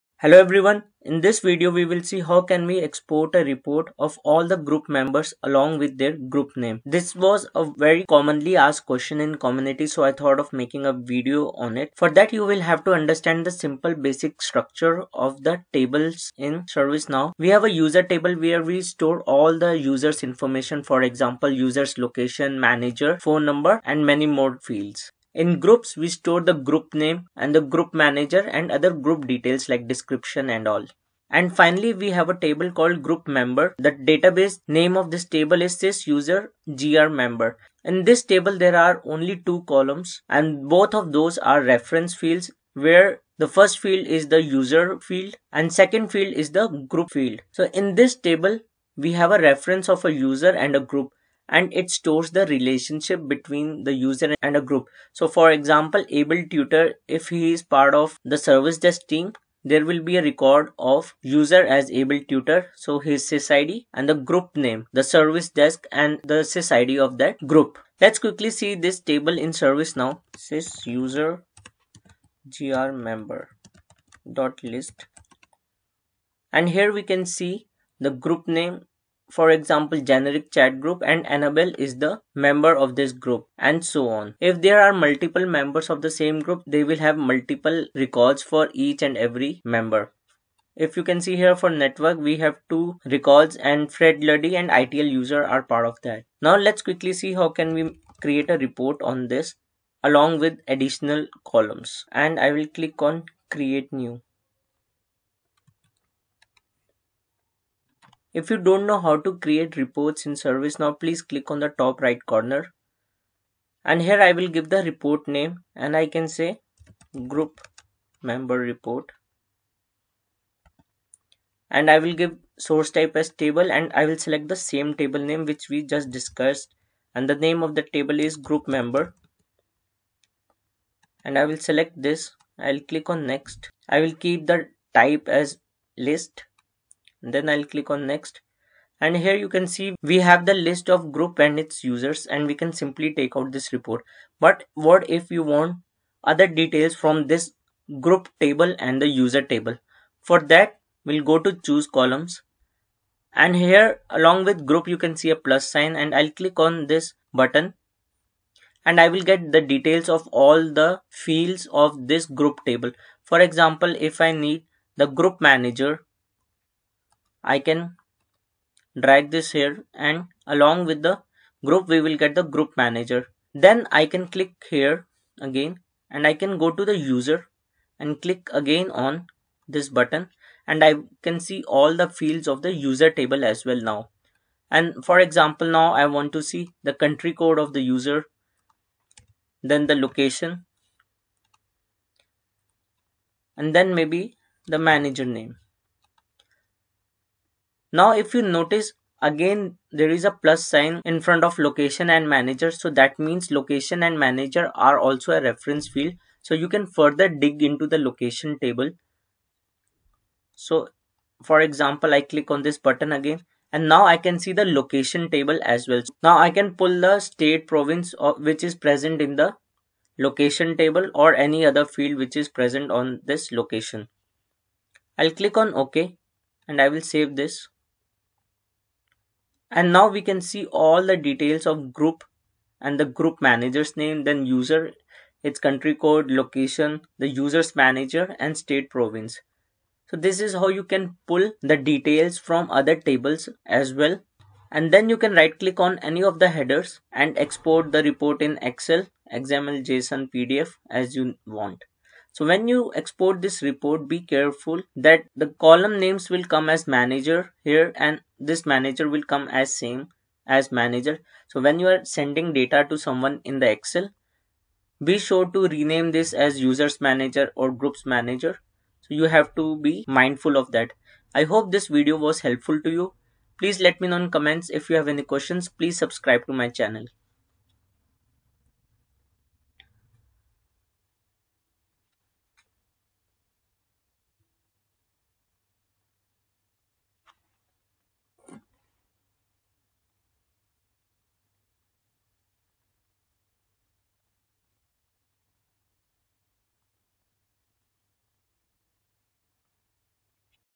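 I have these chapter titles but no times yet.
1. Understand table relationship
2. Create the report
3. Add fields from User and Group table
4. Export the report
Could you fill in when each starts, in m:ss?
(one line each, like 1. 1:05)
1. 0:11
2. 1:36
3. 2:25
4. 4:04.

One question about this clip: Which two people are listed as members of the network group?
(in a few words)
Fred Luddy and ITIL user.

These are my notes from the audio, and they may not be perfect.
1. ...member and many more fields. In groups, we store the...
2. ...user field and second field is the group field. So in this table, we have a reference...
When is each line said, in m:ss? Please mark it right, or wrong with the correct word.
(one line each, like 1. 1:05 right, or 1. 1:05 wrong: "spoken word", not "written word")
1. 0:23 wrong: "number", not "member"
2. 0:44 right.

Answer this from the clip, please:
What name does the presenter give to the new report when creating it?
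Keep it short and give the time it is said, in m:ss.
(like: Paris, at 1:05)
Group member report, at 1:57.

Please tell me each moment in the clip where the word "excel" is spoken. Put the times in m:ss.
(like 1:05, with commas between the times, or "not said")
4:08, 4:23.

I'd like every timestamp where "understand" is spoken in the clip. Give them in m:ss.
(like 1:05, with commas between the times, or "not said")
0:12.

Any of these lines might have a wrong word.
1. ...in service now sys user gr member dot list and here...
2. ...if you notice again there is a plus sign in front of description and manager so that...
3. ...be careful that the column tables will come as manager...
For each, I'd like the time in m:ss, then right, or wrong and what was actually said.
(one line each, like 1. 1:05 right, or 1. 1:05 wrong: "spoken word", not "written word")
1. 1:09 right
2. 3:18 wrong: "location", not "description"
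3. 4:14 wrong: "names", not "tables".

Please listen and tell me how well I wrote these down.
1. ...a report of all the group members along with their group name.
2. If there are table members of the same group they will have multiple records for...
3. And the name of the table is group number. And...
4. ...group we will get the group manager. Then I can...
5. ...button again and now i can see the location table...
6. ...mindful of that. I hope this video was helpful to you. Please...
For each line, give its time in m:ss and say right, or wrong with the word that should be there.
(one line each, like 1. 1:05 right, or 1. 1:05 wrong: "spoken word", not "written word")
1. 0:03 right
2. 1:24 wrong: "multiple", not "table"
3. 2:07 wrong: "member", not "number"
4. 2:51 right
5. 3:32 right
6. 4:30 right.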